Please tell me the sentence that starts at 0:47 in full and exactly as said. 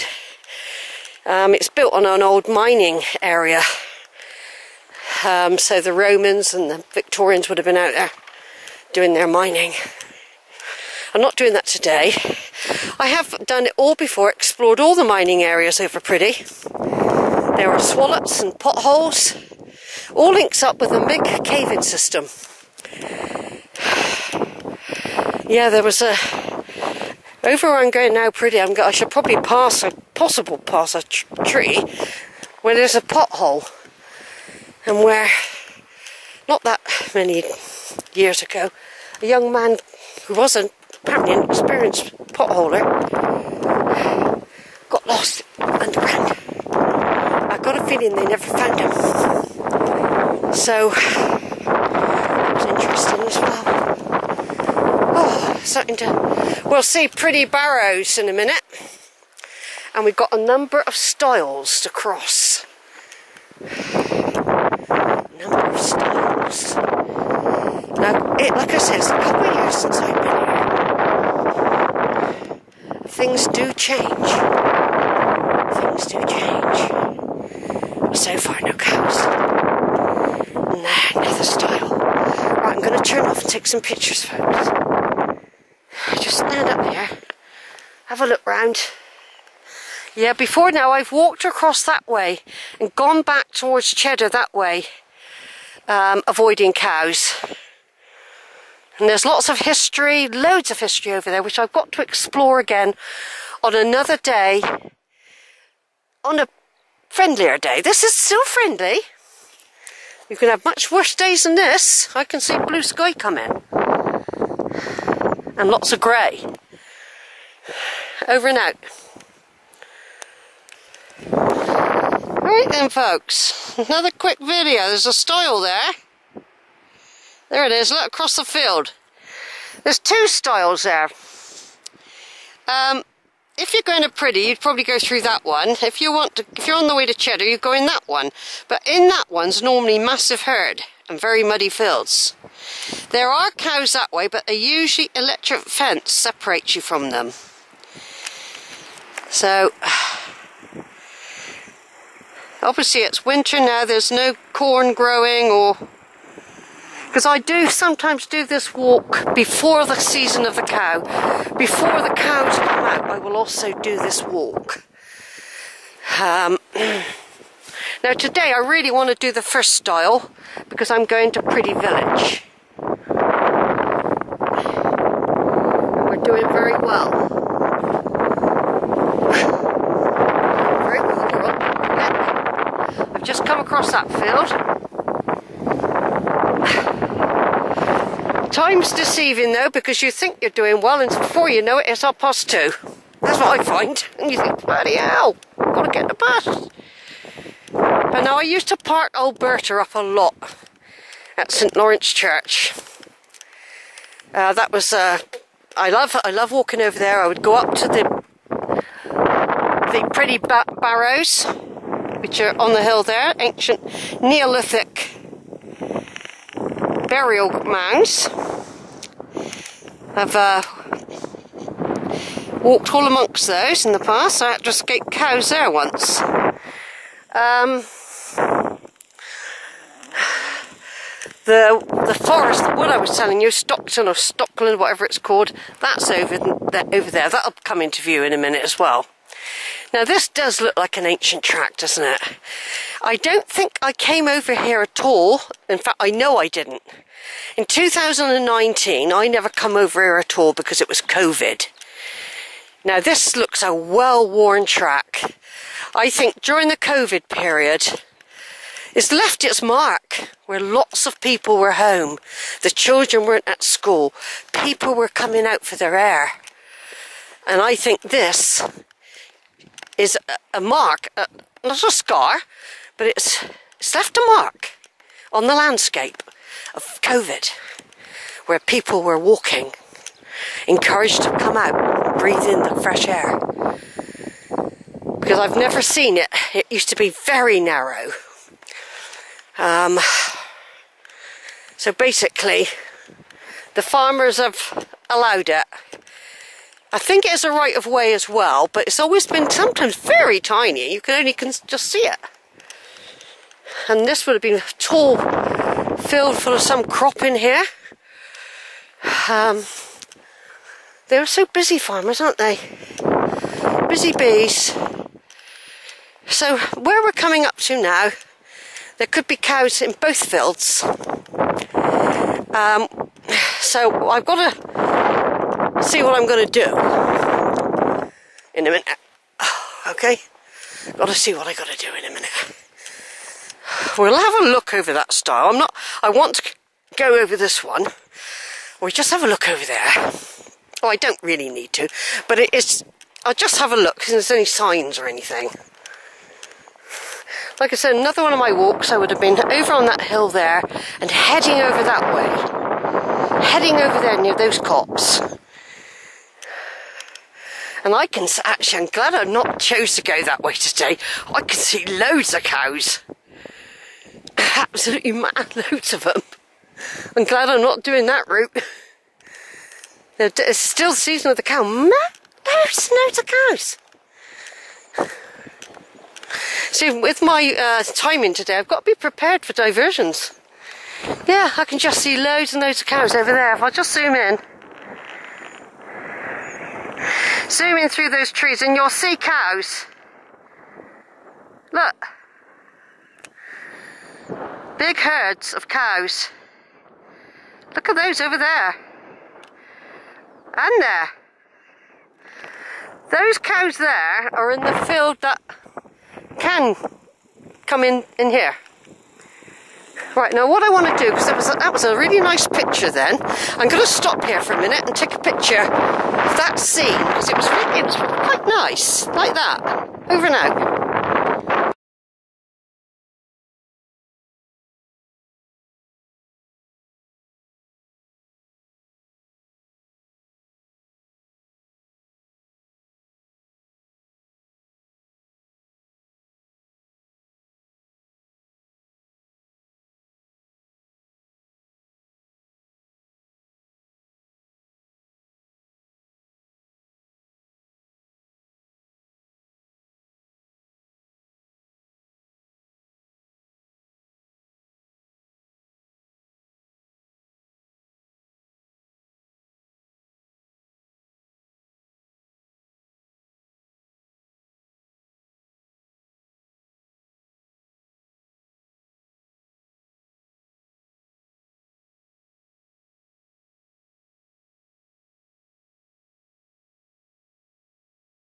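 I got a feeling they never found him.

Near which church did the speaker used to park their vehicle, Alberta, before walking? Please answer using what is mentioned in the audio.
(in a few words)
St Lawrence Church.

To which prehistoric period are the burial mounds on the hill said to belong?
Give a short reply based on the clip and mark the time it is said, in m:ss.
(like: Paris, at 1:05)
Neolithic, at 3:34.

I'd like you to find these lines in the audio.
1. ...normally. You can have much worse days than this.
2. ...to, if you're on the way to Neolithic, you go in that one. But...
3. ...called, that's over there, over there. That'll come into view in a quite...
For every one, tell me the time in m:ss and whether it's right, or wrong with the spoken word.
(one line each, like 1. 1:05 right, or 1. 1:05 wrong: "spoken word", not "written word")
1. 1:48 wrong: "friendly", not "normally"
2. 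2:16 wrong: "Cheddar", not "Neolithic"
3. 3:55 wrong: "minute", not "quite".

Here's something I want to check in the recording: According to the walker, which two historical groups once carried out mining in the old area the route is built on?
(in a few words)
The Romans and the Victorians.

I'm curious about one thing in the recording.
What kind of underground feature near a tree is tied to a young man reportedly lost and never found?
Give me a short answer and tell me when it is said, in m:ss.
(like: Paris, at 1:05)
pothole, at 0:33.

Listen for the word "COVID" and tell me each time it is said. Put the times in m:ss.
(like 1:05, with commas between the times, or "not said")
4:11, 4:16, 4:37.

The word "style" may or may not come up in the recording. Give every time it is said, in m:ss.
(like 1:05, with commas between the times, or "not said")
2:49.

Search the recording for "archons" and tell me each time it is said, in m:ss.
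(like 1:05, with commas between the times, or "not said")
not said.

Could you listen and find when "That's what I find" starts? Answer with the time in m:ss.
3:13.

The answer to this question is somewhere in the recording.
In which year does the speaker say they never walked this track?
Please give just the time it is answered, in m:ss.
4:07.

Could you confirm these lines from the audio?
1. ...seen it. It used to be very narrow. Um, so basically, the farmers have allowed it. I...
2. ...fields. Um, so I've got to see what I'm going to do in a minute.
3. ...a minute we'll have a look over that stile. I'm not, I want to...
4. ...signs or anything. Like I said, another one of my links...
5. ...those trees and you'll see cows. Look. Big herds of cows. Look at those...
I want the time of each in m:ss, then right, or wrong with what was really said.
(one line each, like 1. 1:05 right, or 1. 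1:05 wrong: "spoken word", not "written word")
1. 4:45 right
2. 5:20 right
3. 5:32 right
4. 5:44 wrong: "walks", not "links"
5. 6:28 right.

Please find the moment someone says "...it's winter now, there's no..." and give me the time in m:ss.
2:33.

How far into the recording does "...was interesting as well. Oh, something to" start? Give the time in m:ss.
0:52.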